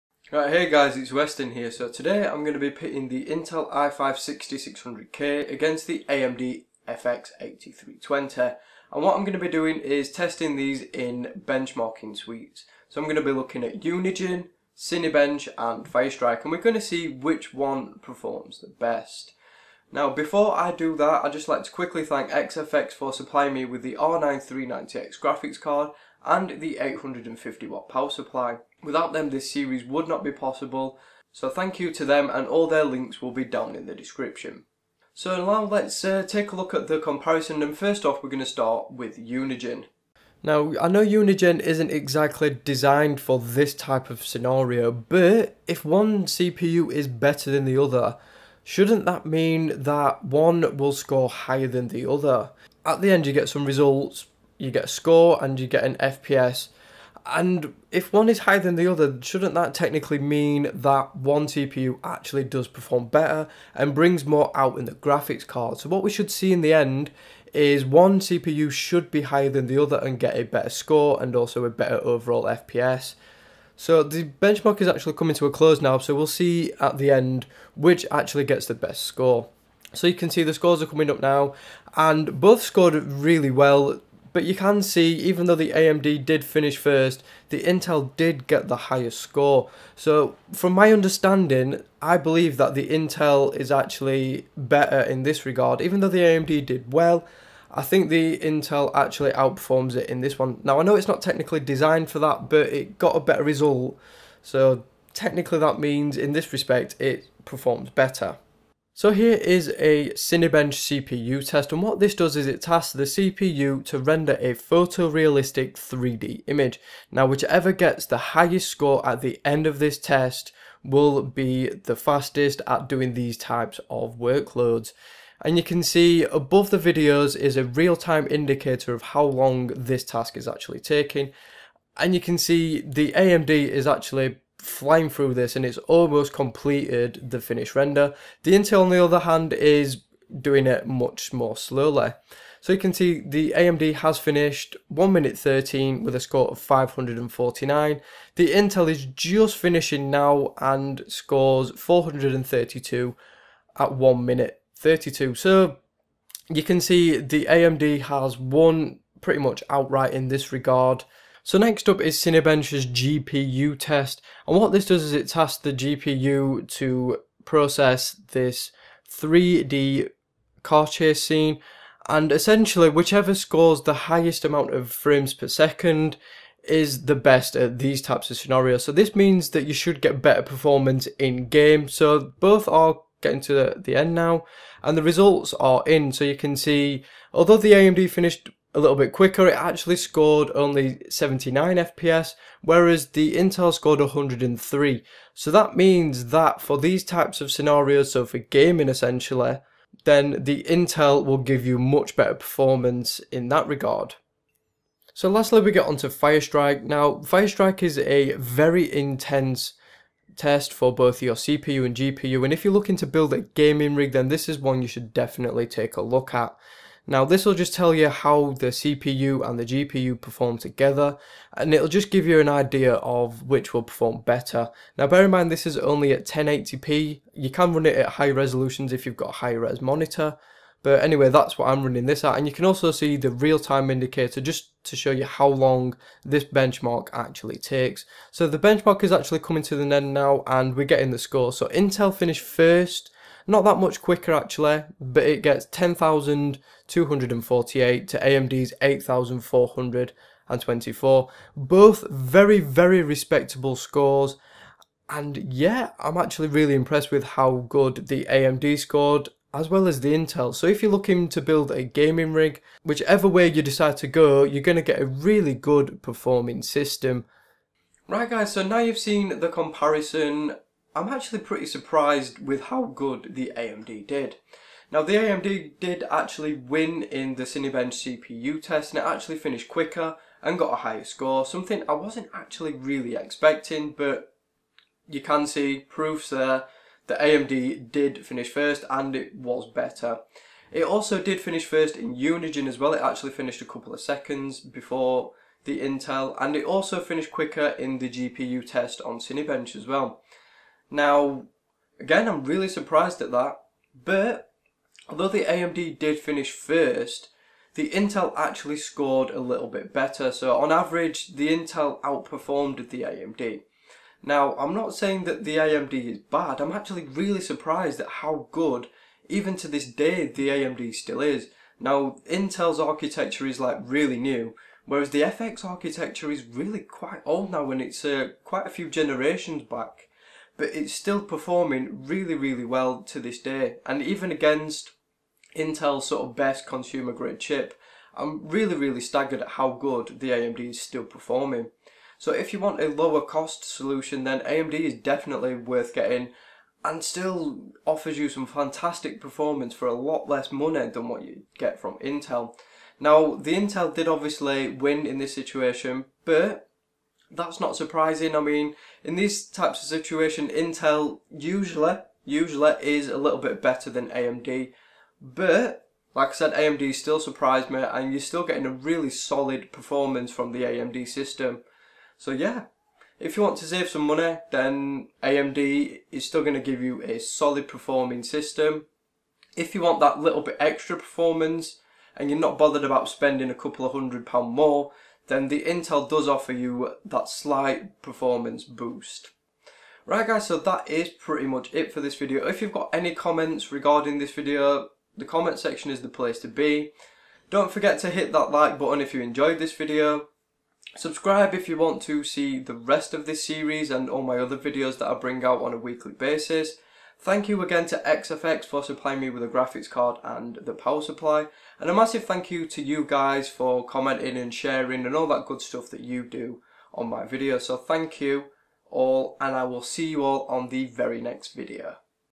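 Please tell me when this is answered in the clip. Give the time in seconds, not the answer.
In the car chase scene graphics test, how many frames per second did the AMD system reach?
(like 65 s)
191 s.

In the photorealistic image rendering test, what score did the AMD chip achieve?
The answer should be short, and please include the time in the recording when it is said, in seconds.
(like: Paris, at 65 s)
549, at 146 s.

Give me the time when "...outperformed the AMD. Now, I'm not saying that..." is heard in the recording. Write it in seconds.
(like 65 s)
312 s.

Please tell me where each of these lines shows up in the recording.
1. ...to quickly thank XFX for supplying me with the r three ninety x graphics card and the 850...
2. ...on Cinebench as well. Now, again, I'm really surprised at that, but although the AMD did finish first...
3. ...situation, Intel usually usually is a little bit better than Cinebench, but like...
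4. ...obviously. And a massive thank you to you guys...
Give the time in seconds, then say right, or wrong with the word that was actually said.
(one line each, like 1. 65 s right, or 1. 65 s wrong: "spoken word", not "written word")
1. 21 s right
2. 299 s right
3. 359 s wrong: "AMD", not "Cinebench"
4. 411 s wrong: "supply", not "obviously".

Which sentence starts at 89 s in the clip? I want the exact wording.
So from my understanding, I believe that the Intel is actually better in this regard.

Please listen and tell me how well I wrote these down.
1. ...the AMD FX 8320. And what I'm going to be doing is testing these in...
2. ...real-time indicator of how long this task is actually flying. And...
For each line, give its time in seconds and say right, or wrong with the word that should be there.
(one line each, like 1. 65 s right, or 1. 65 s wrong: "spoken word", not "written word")
1. 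5 s right
2. 127 s wrong: "taking", not "flying".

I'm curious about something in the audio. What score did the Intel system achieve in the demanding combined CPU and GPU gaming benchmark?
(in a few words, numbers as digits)
10,248.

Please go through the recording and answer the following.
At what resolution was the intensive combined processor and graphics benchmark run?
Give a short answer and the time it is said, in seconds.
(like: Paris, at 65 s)
1080p, at 226 s.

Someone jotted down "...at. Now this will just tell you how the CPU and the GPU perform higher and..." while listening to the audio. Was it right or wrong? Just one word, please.
wrong.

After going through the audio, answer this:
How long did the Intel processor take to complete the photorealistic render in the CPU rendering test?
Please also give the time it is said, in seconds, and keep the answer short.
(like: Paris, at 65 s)
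1 minute 32, at 153 s.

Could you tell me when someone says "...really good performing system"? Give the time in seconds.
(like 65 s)
265 s.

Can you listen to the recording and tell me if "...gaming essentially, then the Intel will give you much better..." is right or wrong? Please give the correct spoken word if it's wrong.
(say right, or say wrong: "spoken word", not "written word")
right.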